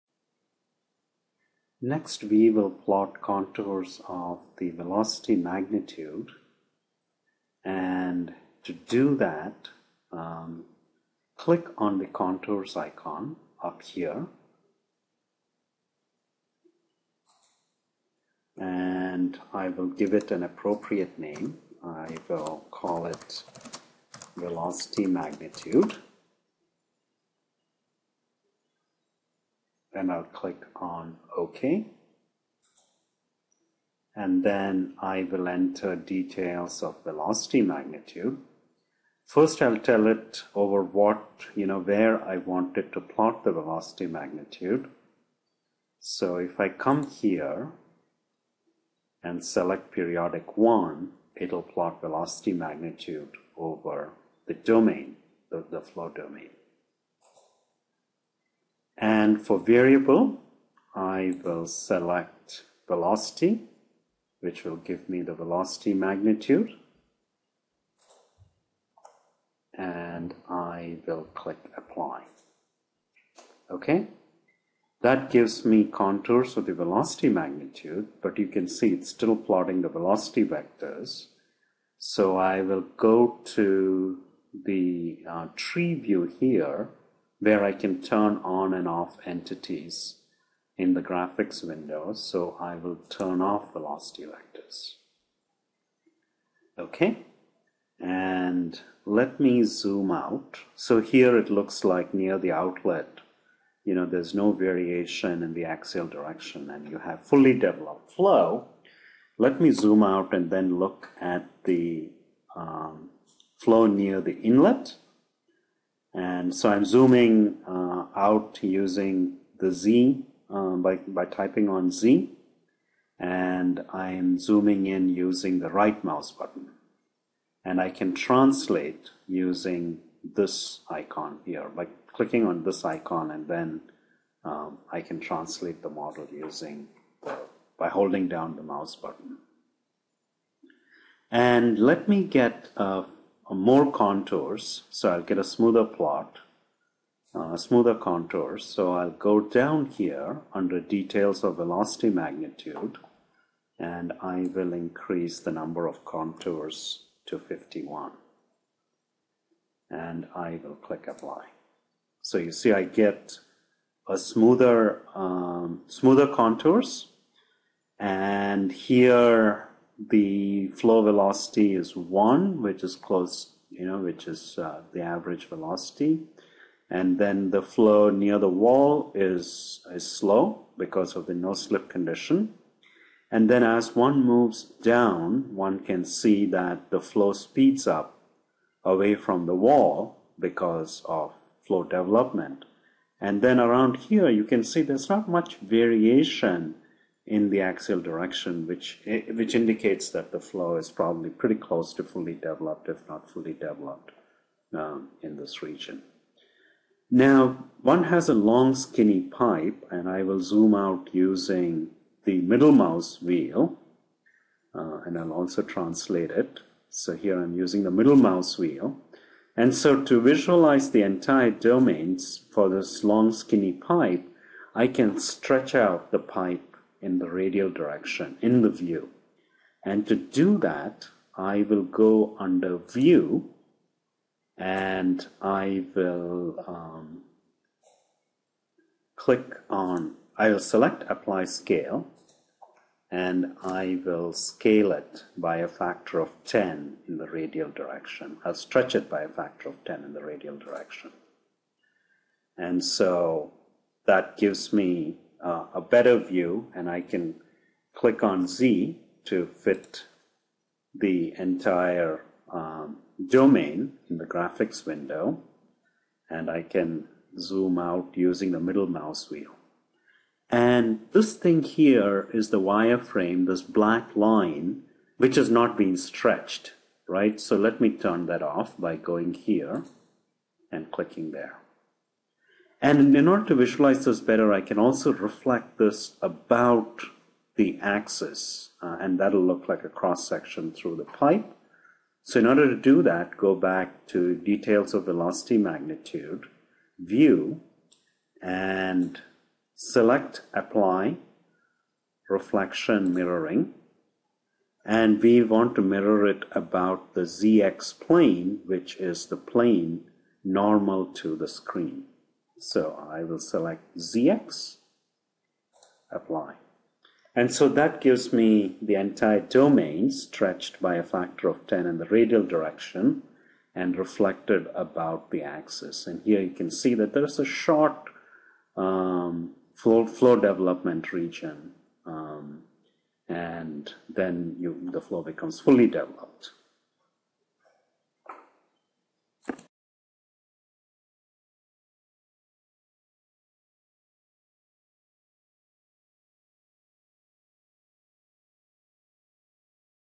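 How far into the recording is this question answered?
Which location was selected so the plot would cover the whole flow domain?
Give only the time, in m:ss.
0:49.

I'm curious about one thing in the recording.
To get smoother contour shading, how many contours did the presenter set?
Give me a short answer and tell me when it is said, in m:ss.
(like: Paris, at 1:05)
51, at 2:37.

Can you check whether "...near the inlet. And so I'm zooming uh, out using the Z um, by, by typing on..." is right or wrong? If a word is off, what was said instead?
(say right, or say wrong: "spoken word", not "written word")
right.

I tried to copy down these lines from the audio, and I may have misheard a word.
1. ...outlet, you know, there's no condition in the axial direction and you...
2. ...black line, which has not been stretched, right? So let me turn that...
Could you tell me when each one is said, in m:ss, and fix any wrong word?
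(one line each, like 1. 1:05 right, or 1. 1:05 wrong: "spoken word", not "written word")
1. 1:42 wrong: "variation", not "condition"
2. 4:33 right.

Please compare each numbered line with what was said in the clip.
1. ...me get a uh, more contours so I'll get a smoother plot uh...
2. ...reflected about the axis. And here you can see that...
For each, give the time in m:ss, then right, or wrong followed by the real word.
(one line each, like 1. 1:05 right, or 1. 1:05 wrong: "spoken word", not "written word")
1. 2:22 right
2. 5:23 right.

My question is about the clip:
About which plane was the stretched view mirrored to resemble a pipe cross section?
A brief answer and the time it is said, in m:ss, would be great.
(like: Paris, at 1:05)
ZX plane, at 5:07.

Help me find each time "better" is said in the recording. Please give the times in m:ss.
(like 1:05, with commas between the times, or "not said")
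4:15, 4:44.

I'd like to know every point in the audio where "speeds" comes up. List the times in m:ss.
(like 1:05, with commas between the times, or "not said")
3:07.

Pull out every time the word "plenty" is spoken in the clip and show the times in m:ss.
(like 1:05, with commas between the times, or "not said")
not said.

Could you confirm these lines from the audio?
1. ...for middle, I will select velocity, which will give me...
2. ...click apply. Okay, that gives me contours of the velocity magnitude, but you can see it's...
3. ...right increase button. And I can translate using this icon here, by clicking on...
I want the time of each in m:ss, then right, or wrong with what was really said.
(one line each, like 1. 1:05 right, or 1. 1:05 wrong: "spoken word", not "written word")
1. 0:59 wrong: "variable", not "middle"
2. 1:11 right
3. 2:05 wrong: "mouse", not "increase".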